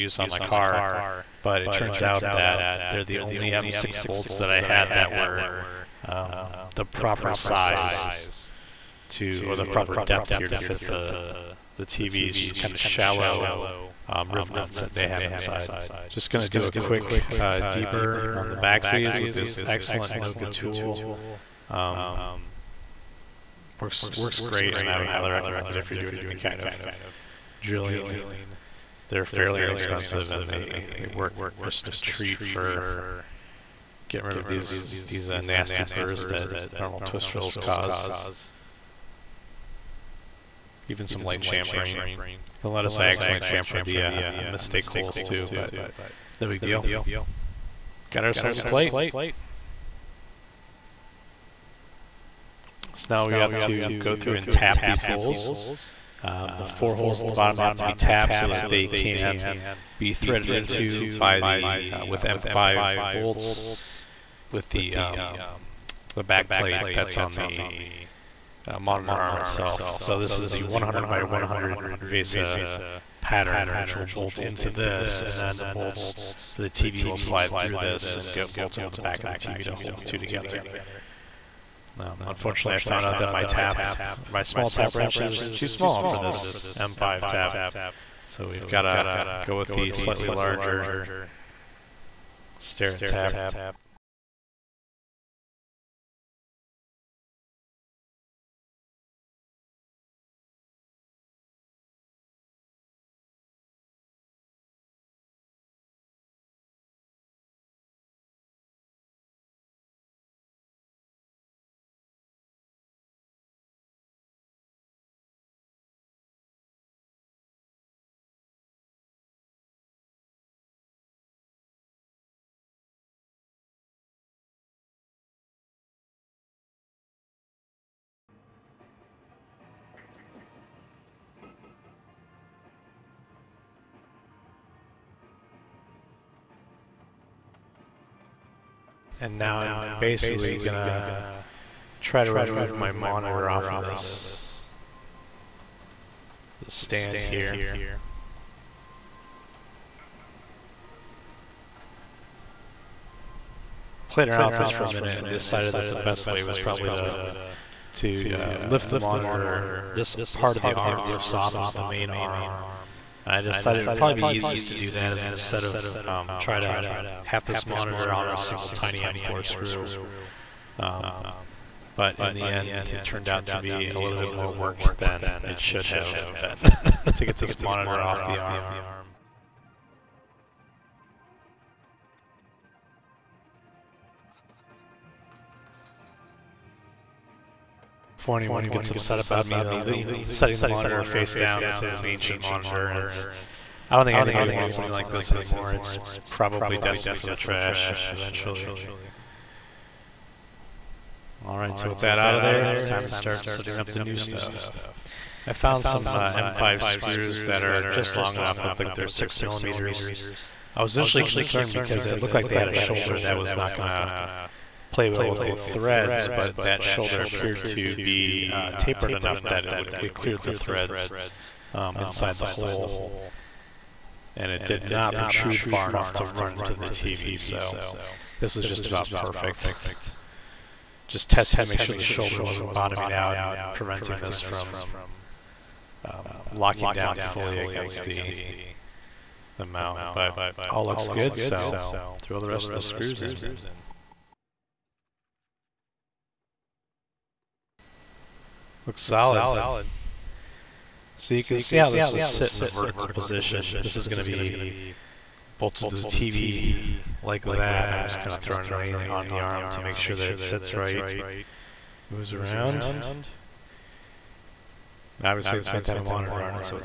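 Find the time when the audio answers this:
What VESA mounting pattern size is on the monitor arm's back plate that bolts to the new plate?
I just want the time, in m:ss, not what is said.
1:10.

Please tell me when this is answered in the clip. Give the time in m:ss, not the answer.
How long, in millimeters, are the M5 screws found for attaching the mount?
3:29.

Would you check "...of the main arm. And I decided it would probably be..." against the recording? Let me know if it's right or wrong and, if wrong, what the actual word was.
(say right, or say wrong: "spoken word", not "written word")
right.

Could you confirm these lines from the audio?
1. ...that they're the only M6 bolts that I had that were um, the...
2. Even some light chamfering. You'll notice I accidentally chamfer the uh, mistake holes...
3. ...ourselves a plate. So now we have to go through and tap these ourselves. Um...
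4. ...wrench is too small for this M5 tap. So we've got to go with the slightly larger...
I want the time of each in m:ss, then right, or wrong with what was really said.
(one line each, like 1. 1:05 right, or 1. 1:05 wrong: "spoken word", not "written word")
1. 0:02 right
2. 0:40 right
3. 0:48 wrong: "holes", not "ourselves"
4. 1:24 right.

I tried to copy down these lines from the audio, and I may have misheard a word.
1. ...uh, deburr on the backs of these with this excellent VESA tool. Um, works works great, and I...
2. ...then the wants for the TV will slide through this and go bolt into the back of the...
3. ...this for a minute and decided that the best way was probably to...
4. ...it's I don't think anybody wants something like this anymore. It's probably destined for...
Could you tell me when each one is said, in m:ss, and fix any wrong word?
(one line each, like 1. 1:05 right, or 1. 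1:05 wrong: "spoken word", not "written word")
1. 0:17 wrong: "Noga", not "VESA"
2. 1:15 wrong: "bolts", not "wants"
3. 2:34 right
4. 3:13 right.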